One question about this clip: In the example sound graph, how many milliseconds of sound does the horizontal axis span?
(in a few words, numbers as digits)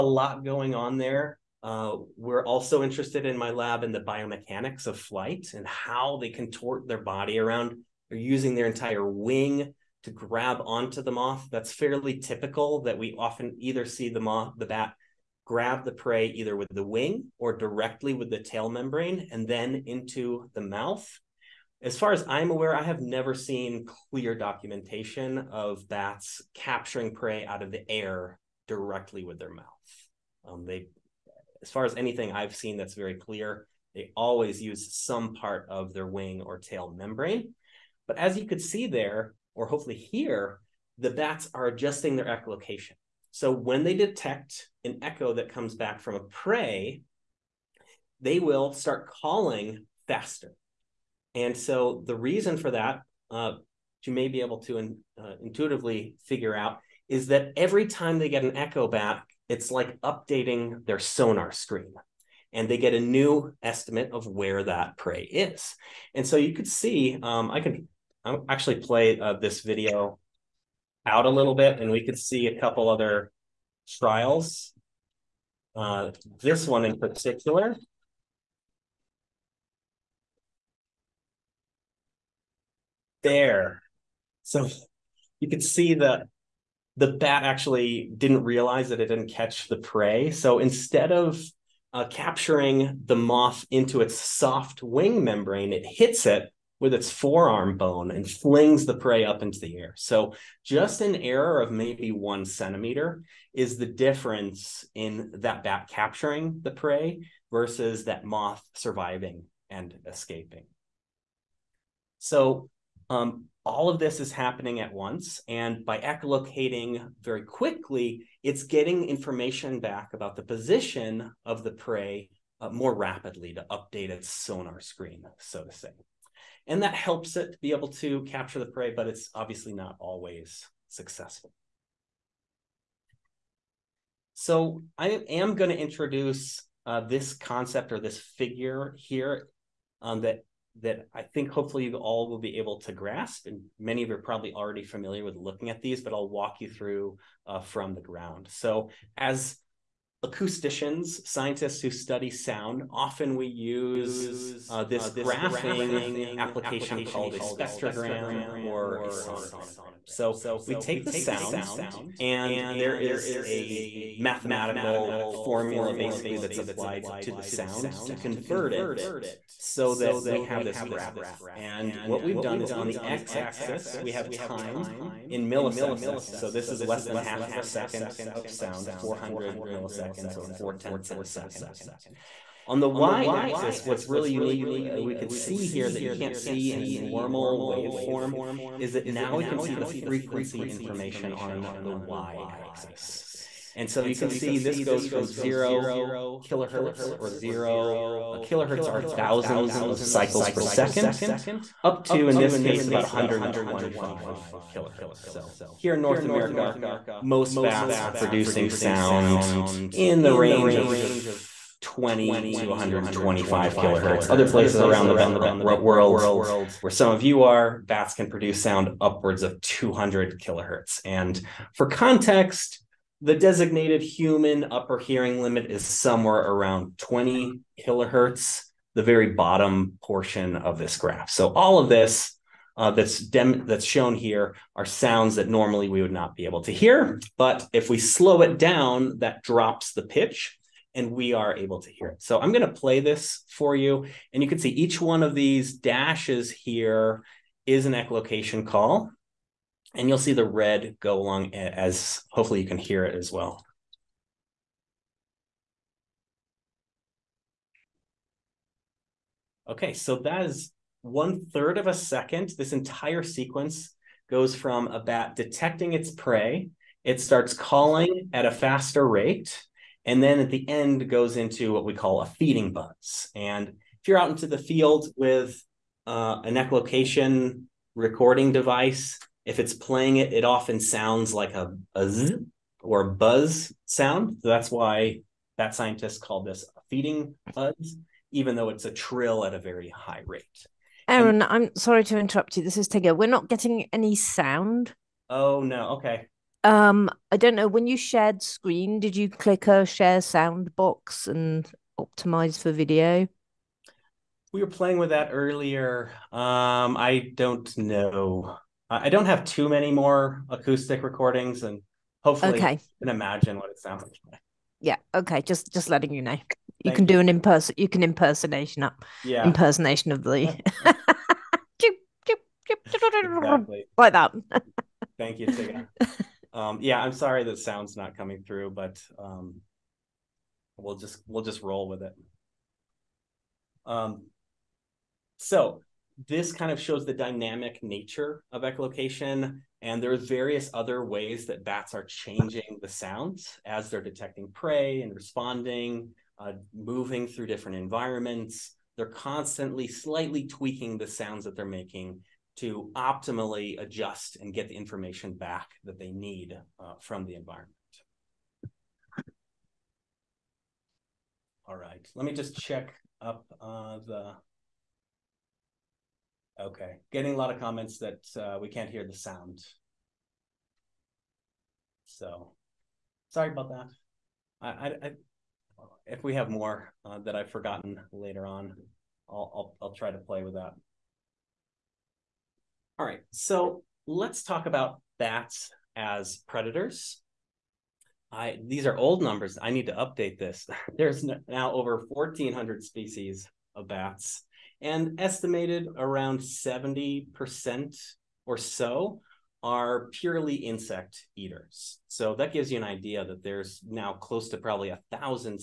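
400 milliseconds.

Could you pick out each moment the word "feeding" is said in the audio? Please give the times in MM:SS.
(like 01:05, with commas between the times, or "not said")
04:32, 04:46.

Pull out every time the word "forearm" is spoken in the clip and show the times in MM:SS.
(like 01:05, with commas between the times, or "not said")
01:37.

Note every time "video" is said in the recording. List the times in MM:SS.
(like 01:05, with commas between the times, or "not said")
01:09, 05:02.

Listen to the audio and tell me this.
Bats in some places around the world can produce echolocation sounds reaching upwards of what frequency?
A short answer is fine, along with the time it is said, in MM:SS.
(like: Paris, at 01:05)
200 kilohertz, at 03:39.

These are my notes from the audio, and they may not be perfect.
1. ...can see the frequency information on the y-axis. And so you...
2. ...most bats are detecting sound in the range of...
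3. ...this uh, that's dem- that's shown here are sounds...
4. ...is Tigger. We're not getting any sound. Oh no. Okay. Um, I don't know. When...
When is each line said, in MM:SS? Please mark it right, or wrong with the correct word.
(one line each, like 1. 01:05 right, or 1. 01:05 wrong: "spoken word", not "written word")
1. 03:09 right
2. 03:27 wrong: "producing", not "detecting"
3. 03:51 right
4. 04:52 right.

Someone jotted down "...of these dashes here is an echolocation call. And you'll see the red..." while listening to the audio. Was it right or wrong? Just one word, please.
right.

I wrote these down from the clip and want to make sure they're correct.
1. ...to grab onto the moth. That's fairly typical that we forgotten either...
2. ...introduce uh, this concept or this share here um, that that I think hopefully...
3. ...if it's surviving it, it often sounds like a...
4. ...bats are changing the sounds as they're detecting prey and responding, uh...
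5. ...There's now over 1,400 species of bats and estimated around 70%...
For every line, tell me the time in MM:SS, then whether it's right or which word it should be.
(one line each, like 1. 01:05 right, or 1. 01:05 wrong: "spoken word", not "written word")
1. 00:10 wrong: "often", not "forgotten"
2. 02:15 wrong: "figure", not "share"
3. 04:39 wrong: "playing", not "surviving"
4. 05:41 right
5. 06:30 right.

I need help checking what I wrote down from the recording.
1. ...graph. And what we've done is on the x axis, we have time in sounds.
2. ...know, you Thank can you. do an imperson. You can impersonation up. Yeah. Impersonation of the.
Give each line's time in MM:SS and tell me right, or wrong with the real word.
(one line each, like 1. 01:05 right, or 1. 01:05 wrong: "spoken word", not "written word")
1. 02:50 wrong: "milliseconds", not "sounds"
2. 05:16 right.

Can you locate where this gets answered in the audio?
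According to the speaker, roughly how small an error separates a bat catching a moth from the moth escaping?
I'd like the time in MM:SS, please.
01:42.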